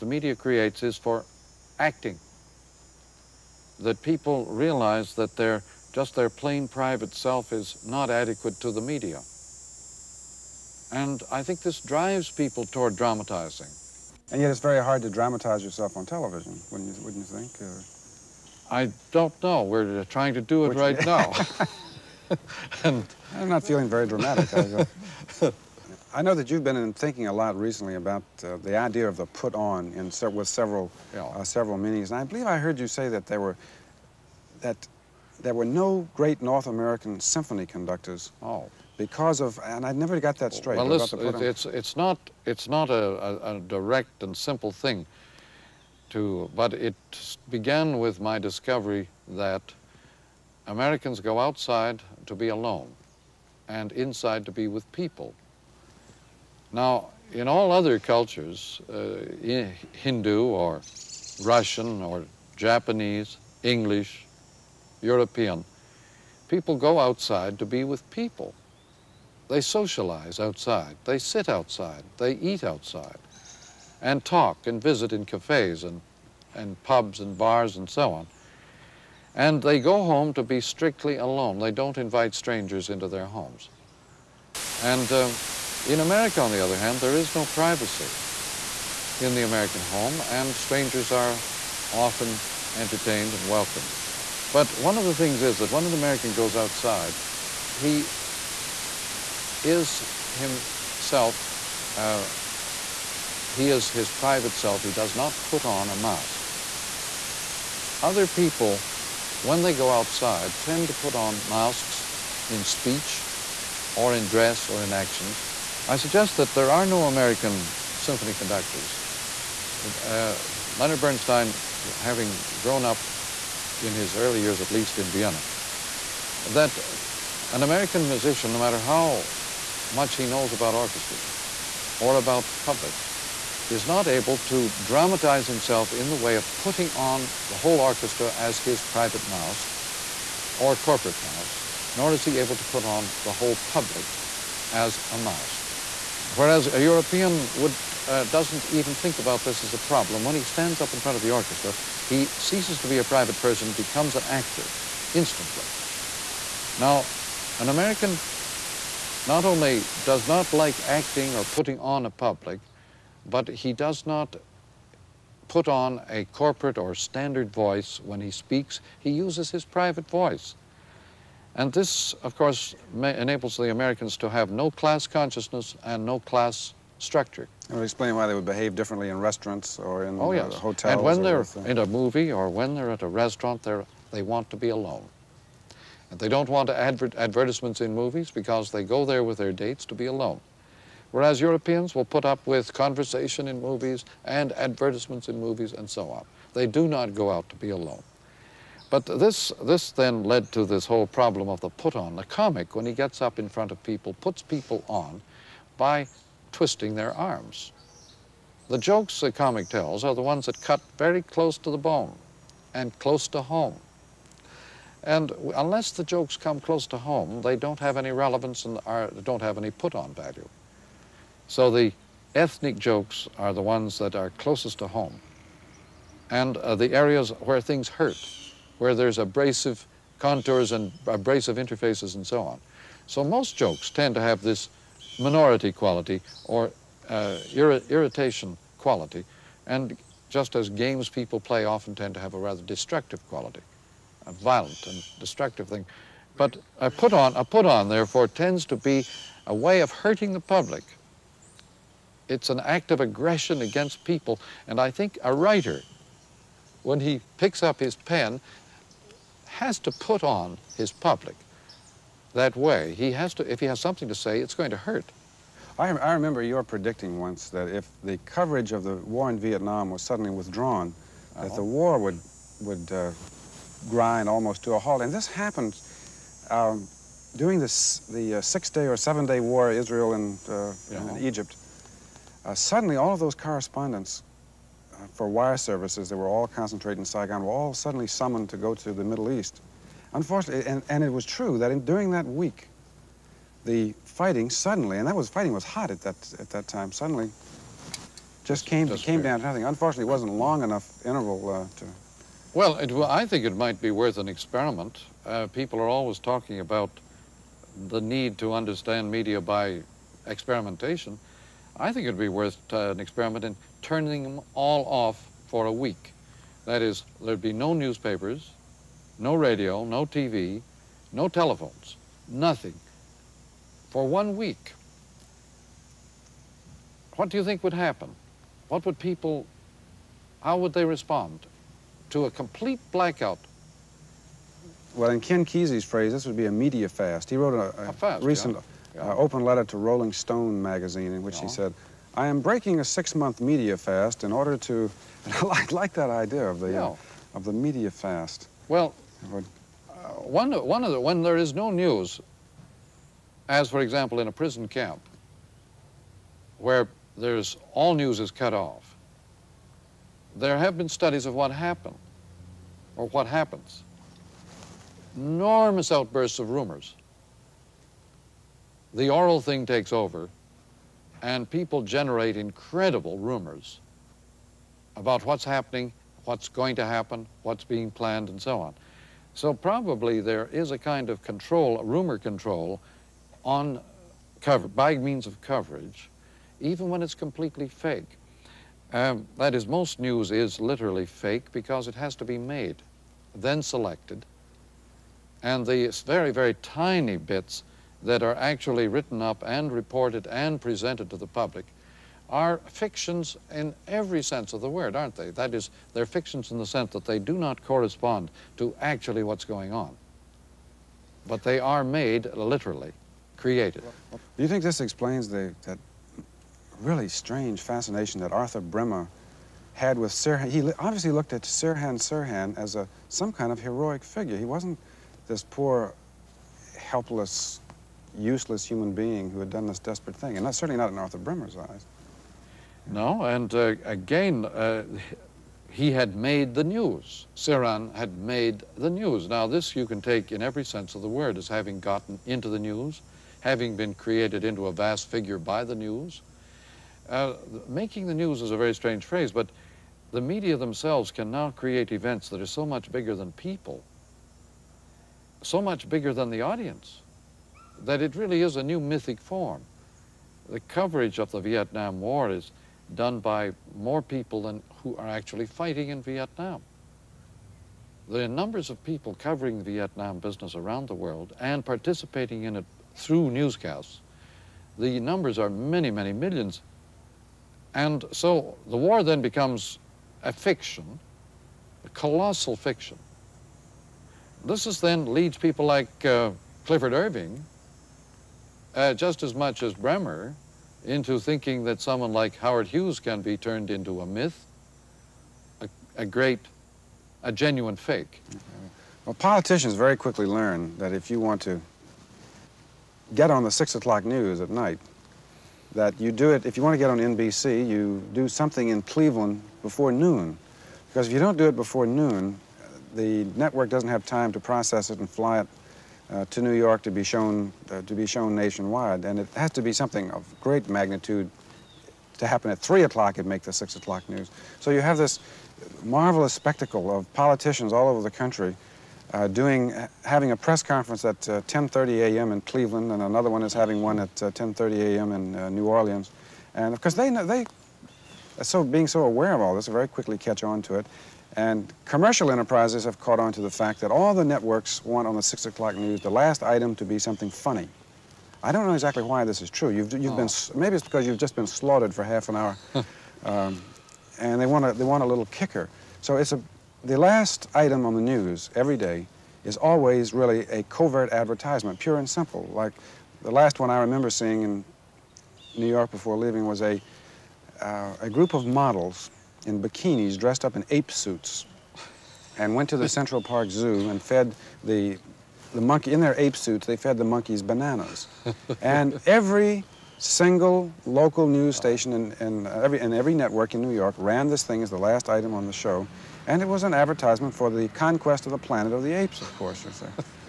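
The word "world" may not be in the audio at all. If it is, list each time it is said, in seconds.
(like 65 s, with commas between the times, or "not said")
470 s.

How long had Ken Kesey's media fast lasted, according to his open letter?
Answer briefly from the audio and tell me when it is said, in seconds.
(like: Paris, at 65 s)
6 months, at 342 s.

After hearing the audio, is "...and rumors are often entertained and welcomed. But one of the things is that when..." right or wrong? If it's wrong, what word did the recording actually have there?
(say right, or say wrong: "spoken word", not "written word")
wrong: "strangers", not "rumors".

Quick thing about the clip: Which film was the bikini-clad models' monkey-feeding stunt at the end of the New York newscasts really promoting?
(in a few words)
Conquest of the Planet of the Apes.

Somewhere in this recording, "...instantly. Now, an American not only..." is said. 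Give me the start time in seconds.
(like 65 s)
155 s.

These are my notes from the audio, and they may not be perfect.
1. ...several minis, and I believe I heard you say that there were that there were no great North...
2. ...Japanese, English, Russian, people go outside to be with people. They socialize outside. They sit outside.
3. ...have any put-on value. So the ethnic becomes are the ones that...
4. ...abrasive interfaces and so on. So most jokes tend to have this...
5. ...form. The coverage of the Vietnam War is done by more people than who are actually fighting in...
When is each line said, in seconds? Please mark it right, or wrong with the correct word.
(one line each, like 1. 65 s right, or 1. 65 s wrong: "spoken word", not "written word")
1. 31 s right
2. 62 s wrong: "European", not "Russian"
3. 219 s wrong: "jokes", not "becomes"
4. 231 s right
5. 459 s right.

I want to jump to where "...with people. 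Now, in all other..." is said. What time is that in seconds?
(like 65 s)
54 s.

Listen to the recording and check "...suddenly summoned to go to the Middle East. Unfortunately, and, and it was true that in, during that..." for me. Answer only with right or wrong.
right.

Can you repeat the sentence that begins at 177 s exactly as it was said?
it explain why they would behave differently in restaurants or in oh, uh, yes.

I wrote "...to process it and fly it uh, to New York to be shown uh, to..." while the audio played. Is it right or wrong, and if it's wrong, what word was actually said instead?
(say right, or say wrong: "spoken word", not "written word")
right.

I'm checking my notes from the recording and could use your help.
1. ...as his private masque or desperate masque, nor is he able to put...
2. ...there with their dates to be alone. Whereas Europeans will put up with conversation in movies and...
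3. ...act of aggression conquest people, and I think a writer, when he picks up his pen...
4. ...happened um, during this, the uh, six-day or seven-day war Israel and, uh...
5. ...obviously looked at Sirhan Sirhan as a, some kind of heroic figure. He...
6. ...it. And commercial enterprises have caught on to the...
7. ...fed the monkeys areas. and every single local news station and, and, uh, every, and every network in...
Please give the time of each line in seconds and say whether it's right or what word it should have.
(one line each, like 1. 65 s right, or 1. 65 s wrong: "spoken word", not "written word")
1. 138 s wrong: "corporate", not "desperate"
2. 189 s right
3. 252 s wrong: "against", not "conquest"
4. 275 s right
5. 420 s right
6. 540 s right
7. 576 s wrong: "bananas", not "areas".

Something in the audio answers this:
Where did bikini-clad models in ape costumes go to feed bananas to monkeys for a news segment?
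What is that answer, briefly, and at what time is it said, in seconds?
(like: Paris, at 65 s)
Central Park Zoo, at 572 s.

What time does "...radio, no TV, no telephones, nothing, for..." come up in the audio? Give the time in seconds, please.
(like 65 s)
319 s.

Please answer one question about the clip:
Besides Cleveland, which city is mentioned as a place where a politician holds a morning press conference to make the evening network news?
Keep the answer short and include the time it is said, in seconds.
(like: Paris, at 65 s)
New Orleans, at 535 s.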